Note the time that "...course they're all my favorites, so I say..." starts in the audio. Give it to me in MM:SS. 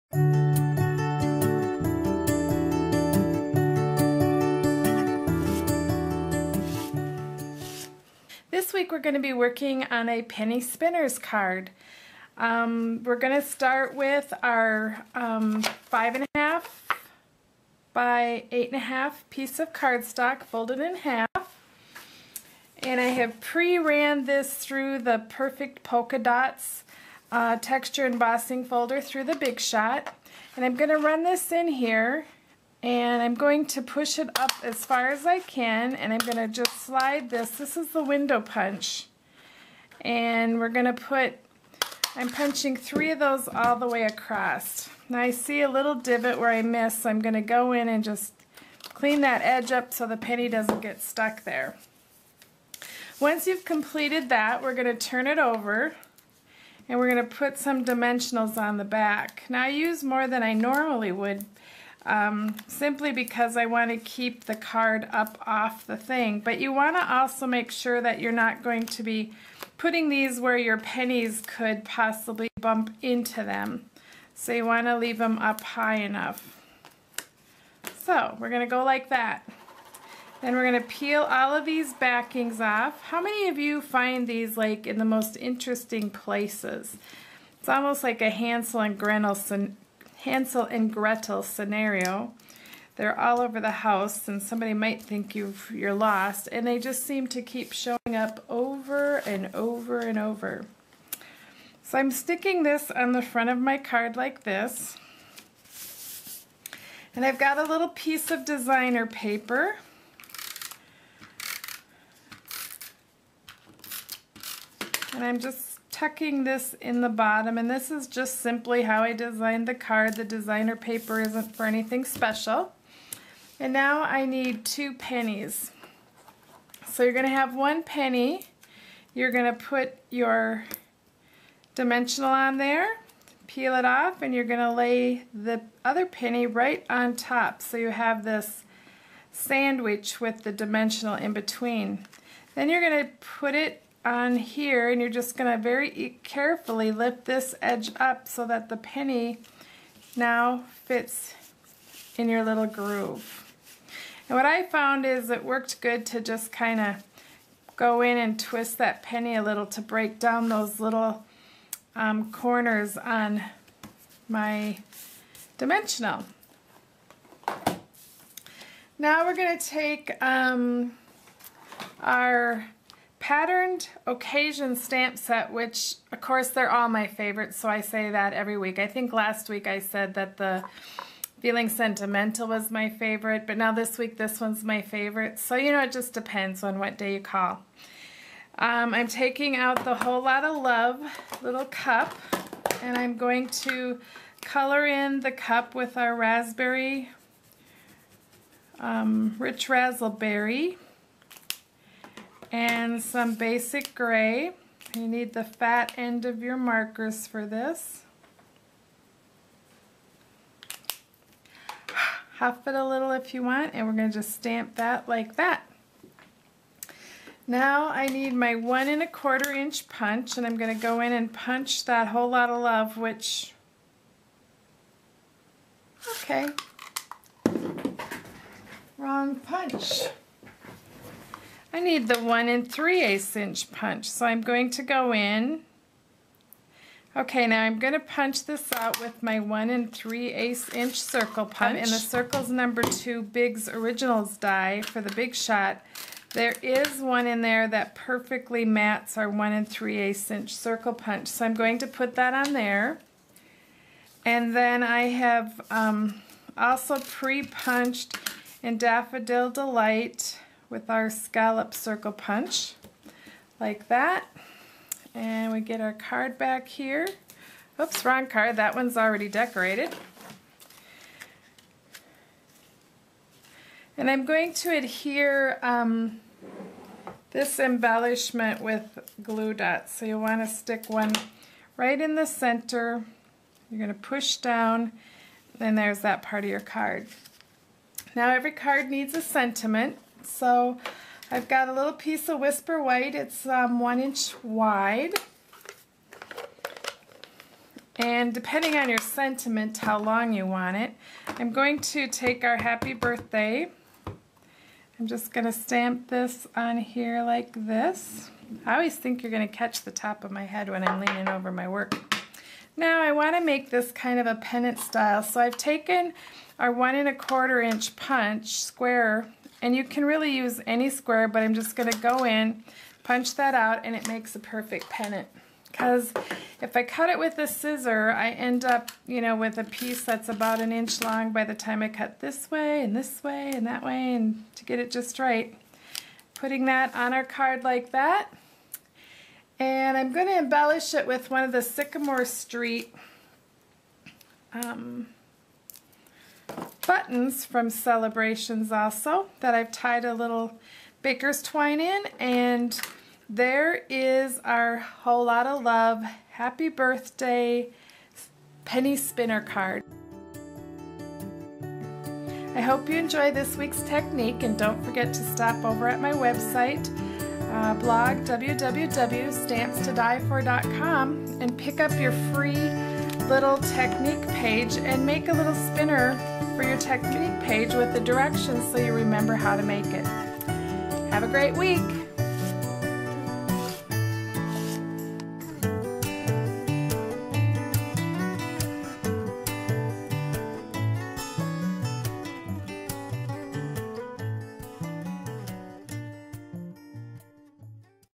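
02:56.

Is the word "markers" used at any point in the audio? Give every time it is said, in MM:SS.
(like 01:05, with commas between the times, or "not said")
03:26.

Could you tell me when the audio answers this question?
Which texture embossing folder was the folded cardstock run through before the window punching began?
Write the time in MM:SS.
00:25.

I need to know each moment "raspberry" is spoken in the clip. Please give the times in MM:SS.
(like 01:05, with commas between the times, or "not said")
03:16.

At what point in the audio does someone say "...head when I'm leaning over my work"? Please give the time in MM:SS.
05:10.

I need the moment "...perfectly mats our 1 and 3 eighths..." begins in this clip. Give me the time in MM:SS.
04:07.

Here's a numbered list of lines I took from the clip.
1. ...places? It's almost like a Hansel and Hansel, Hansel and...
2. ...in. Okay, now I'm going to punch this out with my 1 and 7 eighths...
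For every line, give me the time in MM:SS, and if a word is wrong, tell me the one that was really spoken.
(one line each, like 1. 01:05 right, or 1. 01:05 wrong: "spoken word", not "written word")
1. 01:26 wrong: "Gretel", not "Hansel"
2. 03:55 wrong: "3", not "7".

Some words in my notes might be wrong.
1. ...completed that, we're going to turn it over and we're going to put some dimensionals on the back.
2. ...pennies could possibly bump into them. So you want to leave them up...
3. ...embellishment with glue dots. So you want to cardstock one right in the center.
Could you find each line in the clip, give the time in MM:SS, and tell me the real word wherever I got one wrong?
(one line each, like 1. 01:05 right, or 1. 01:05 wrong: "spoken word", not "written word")
1. 00:53 right
2. 01:10 right
3. 04:37 wrong: "stick", not "cardstock".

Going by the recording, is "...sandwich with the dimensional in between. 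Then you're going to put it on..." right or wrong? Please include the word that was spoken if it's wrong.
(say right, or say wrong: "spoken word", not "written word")
right.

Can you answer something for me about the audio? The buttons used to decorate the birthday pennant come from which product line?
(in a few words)
Sycamore Street.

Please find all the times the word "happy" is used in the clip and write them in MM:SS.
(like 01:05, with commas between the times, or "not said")
05:02, 05:56.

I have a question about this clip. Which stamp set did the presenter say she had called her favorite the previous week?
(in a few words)
Feeling Sentimental.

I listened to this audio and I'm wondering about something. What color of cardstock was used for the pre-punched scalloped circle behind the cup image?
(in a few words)
Daffodil Delight.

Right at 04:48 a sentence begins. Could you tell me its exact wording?
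Now every card needs a sentiment.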